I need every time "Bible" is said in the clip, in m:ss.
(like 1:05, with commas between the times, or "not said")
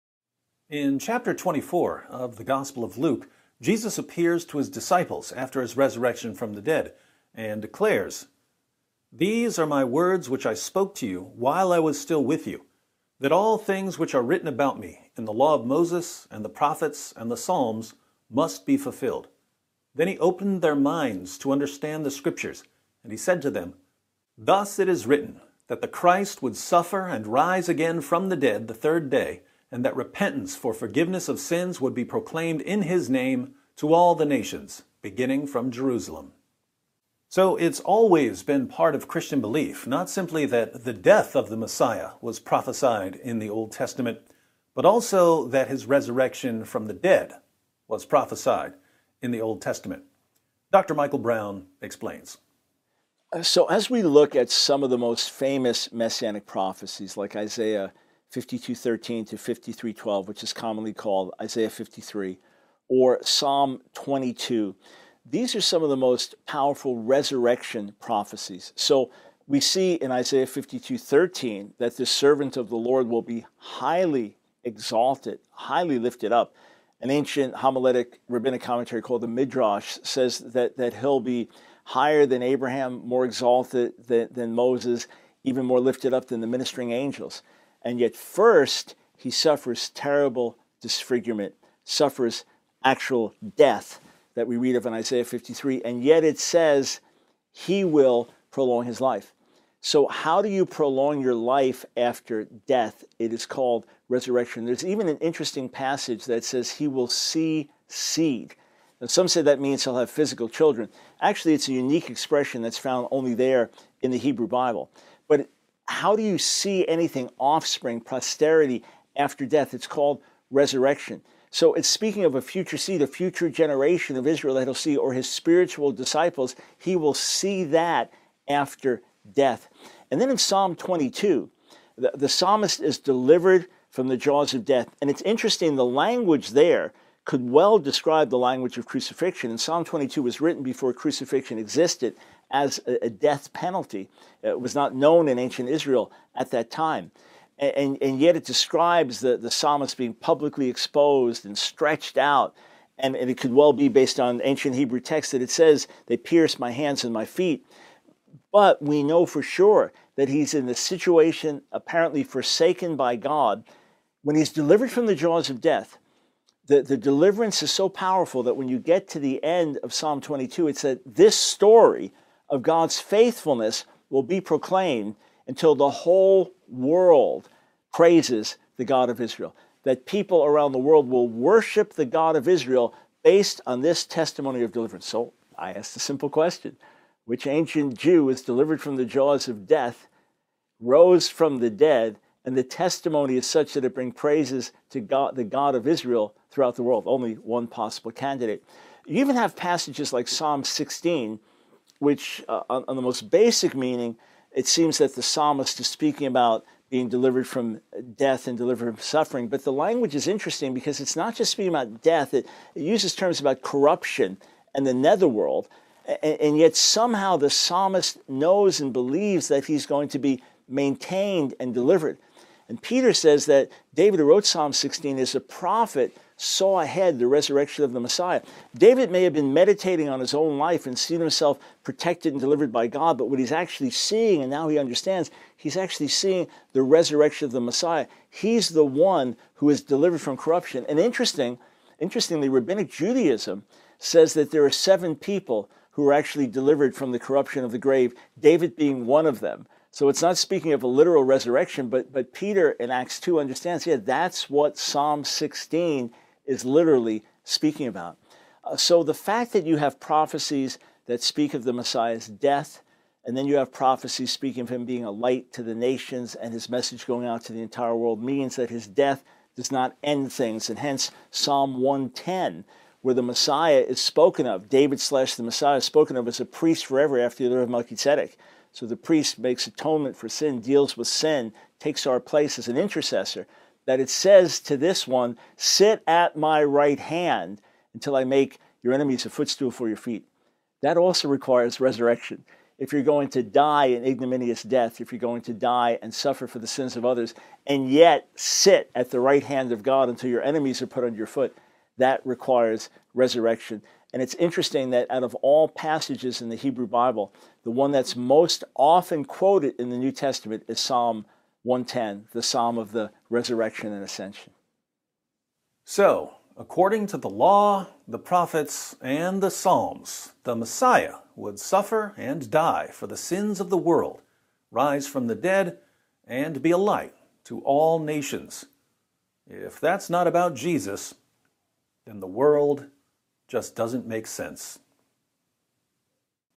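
1:54, 5:06.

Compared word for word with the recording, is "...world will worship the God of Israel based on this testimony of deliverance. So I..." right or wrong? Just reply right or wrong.
right.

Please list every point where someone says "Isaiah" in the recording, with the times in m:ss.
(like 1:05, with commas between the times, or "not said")
0:57, 1:01, 1:10, 1:34.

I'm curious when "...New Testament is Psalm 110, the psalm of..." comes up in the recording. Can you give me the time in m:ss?
5:09.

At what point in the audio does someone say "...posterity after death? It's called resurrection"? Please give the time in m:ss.
1:57.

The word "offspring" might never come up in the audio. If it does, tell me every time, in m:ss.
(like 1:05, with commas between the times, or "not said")
1:57.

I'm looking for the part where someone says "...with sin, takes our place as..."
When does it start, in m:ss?
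4:40.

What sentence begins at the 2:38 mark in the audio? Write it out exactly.
But we know for sure that he's in the situation apparently forsaken by God.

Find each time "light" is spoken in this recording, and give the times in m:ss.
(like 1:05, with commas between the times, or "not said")
4:25, 5:26.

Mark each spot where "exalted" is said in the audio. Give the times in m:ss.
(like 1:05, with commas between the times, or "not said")
1:14, 1:23.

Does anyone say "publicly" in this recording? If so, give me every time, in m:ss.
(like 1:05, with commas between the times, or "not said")
2:30.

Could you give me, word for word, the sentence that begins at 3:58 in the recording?
He's the one who is delivered from corruption.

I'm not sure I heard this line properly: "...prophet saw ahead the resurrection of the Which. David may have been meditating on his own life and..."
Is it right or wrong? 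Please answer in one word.
wrong.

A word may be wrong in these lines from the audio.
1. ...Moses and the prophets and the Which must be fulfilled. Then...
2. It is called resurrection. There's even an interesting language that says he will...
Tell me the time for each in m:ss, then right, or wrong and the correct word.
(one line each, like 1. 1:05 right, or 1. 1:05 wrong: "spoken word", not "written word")
1. 0:15 wrong: "Psalms", not "Which"
2. 1:43 wrong: "passage", not "language".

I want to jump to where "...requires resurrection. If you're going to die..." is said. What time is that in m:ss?
4:51.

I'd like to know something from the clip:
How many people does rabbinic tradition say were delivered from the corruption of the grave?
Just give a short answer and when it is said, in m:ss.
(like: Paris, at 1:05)
7, at 4:04.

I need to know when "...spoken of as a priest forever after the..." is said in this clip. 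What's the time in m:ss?
4:35.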